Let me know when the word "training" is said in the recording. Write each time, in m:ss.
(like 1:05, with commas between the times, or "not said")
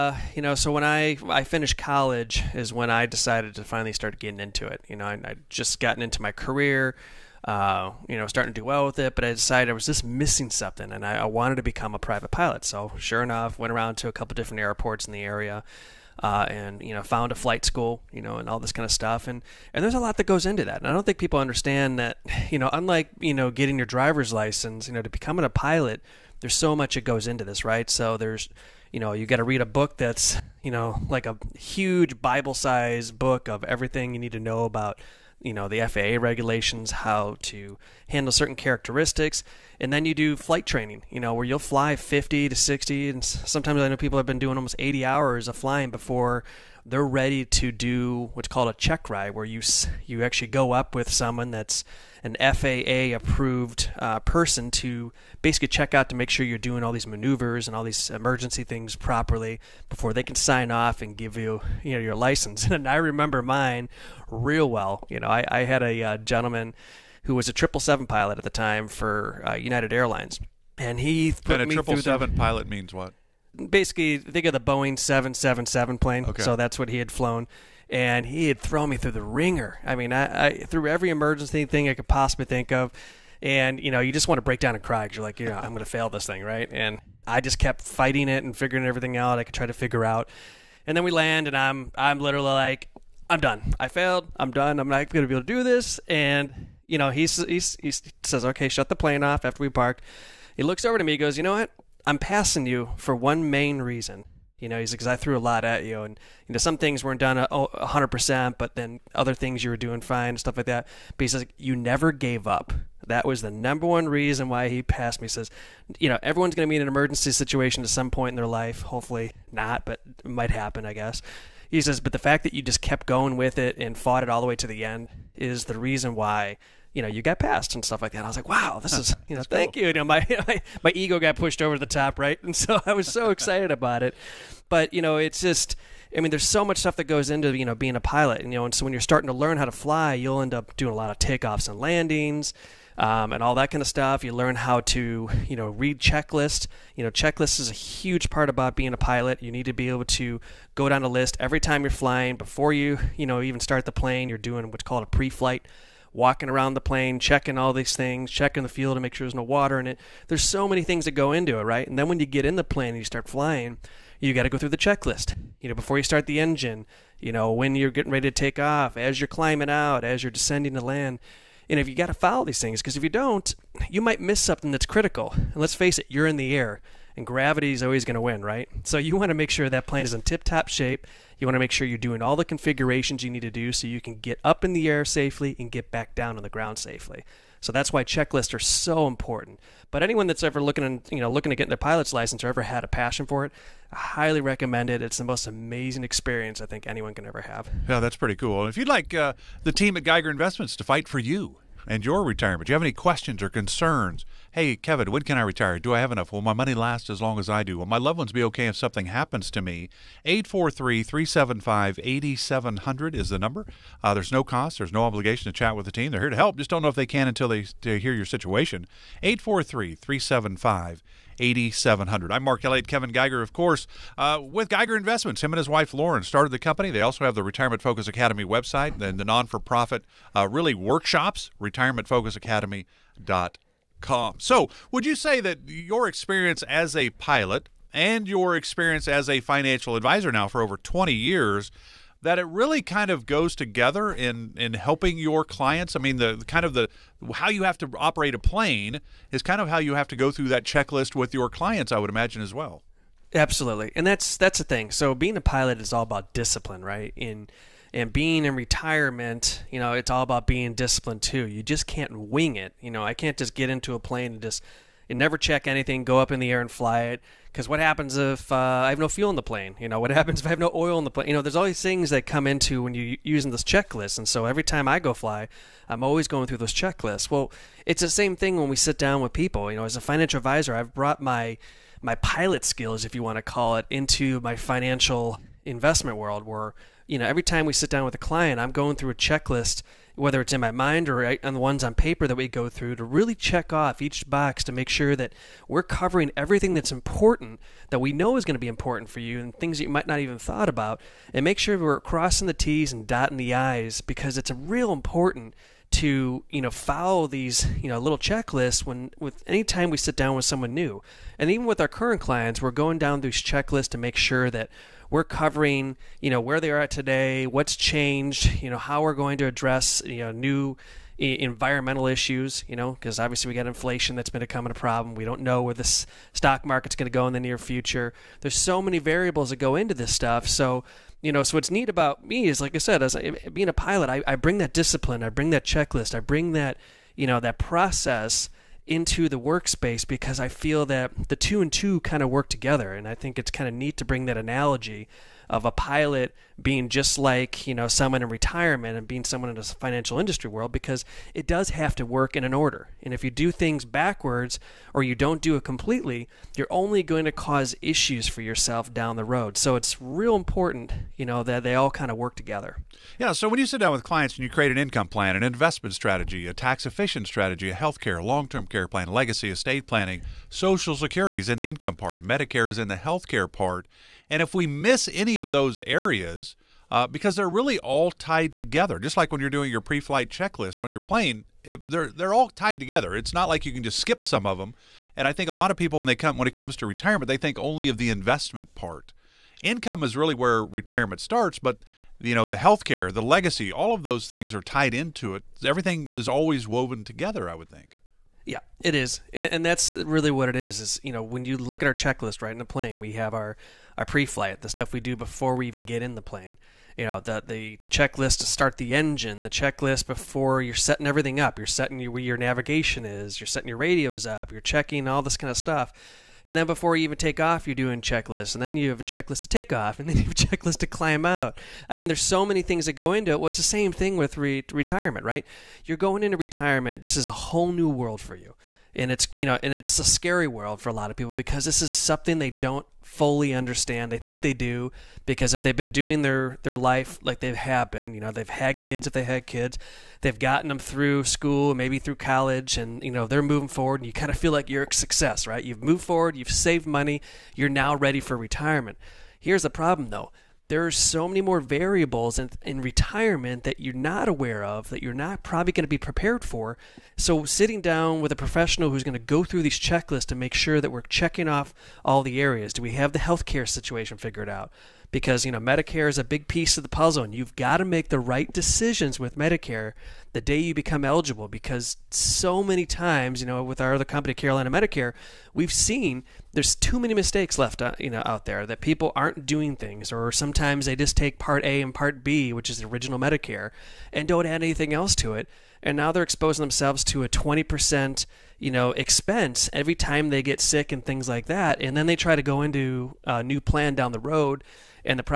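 0:40.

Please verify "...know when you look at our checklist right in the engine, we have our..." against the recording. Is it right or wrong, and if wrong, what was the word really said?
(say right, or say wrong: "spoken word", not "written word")
wrong: "plane", not "engine".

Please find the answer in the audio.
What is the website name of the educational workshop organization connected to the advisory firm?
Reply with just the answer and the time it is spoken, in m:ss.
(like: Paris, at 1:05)
retirementfocusacademy.com, at 3:51.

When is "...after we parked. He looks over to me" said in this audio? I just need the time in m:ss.
1:39.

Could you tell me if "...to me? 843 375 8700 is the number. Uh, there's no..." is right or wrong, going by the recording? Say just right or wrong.
right.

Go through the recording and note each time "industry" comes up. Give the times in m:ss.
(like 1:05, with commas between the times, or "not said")
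5:50.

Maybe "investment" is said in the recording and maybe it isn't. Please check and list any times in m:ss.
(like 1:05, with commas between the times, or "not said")
3:20, 3:44, 4:45, 6:05, 6:28.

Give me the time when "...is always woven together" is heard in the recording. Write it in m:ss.
6:36.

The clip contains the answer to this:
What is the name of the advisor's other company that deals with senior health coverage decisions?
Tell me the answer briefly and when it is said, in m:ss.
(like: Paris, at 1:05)
Carolina Medicare, at 7:54.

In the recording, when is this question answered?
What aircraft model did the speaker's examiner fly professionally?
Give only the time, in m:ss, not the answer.
1:14.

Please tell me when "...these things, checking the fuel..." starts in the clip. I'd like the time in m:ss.
2:37.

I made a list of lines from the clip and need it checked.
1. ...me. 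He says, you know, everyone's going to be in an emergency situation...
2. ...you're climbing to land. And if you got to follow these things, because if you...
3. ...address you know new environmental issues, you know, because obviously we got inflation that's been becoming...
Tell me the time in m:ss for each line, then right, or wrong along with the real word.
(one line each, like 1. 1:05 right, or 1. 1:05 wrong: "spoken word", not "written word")
1. 1:55 right
2. 2:50 wrong: "descending", not "climbing"
3. 5:19 right.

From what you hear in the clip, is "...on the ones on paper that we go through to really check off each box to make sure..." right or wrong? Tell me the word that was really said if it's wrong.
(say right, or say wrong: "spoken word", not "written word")
right.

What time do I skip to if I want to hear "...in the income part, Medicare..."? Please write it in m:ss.
6:11.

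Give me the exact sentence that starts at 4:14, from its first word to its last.
So being a pilot is all about discipline, right?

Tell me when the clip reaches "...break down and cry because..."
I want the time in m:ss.
1:24.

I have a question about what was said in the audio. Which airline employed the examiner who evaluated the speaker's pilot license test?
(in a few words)
United Airlines.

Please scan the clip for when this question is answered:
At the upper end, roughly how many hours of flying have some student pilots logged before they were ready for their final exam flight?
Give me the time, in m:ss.
0:44.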